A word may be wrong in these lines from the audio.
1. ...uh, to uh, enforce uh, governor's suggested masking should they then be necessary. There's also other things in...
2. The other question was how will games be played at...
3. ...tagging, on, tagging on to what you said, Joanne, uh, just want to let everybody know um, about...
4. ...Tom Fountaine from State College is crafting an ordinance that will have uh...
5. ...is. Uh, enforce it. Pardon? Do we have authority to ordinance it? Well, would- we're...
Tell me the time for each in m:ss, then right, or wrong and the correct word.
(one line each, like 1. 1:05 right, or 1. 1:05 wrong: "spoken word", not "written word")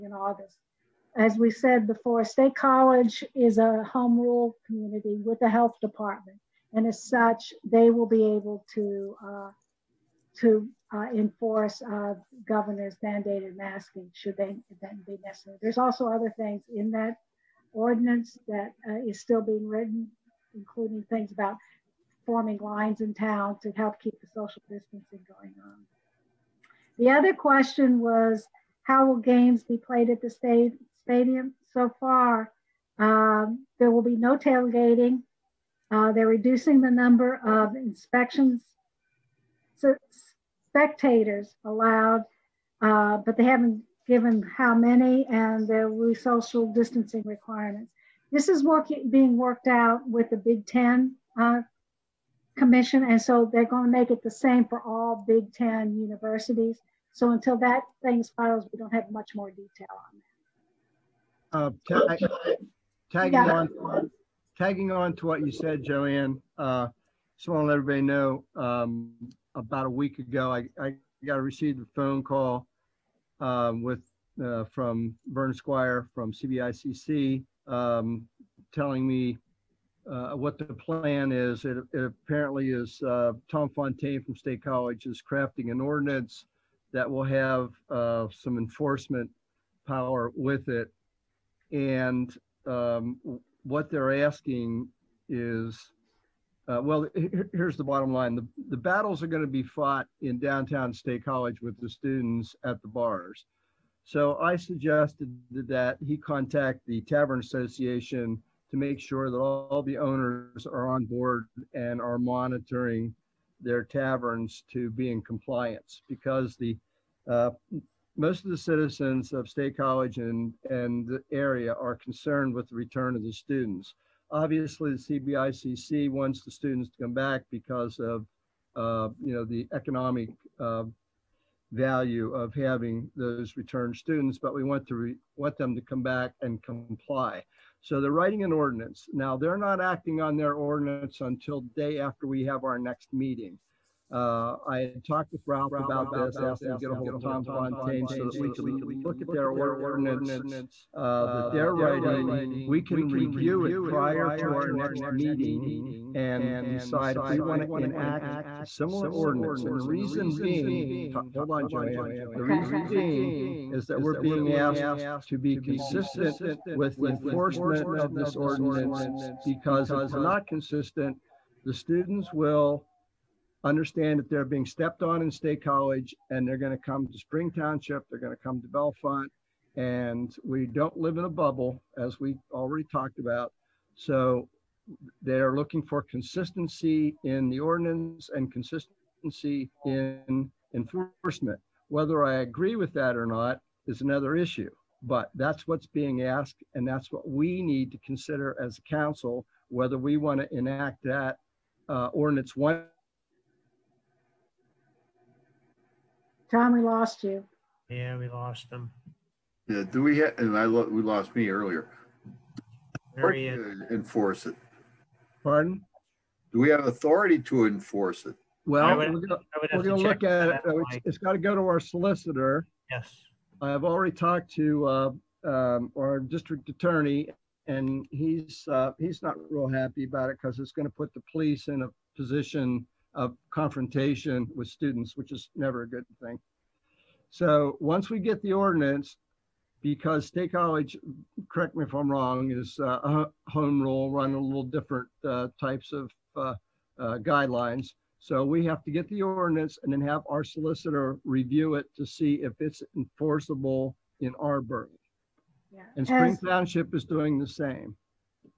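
1. 0:09 wrong: "mandated", not "suggested"
2. 0:26 right
3. 1:03 right
4. 1:23 right
5. 3:33 wrong: "enforce", not "ordinance".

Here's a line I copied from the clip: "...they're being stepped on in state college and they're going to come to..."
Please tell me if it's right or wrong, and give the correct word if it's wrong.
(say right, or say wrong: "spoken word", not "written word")
right.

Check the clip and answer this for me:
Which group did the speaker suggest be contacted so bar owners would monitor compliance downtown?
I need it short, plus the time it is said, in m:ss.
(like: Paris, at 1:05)
Tavern Association, at 1:47.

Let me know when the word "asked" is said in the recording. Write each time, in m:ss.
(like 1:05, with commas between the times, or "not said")
2:26, 2:44, 3:16.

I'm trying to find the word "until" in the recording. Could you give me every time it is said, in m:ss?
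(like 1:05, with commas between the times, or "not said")
0:57, 2:21.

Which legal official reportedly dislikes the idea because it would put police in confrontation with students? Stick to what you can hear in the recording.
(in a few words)
district attorney.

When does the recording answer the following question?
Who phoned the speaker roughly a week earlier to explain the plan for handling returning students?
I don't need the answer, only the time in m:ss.
1:15.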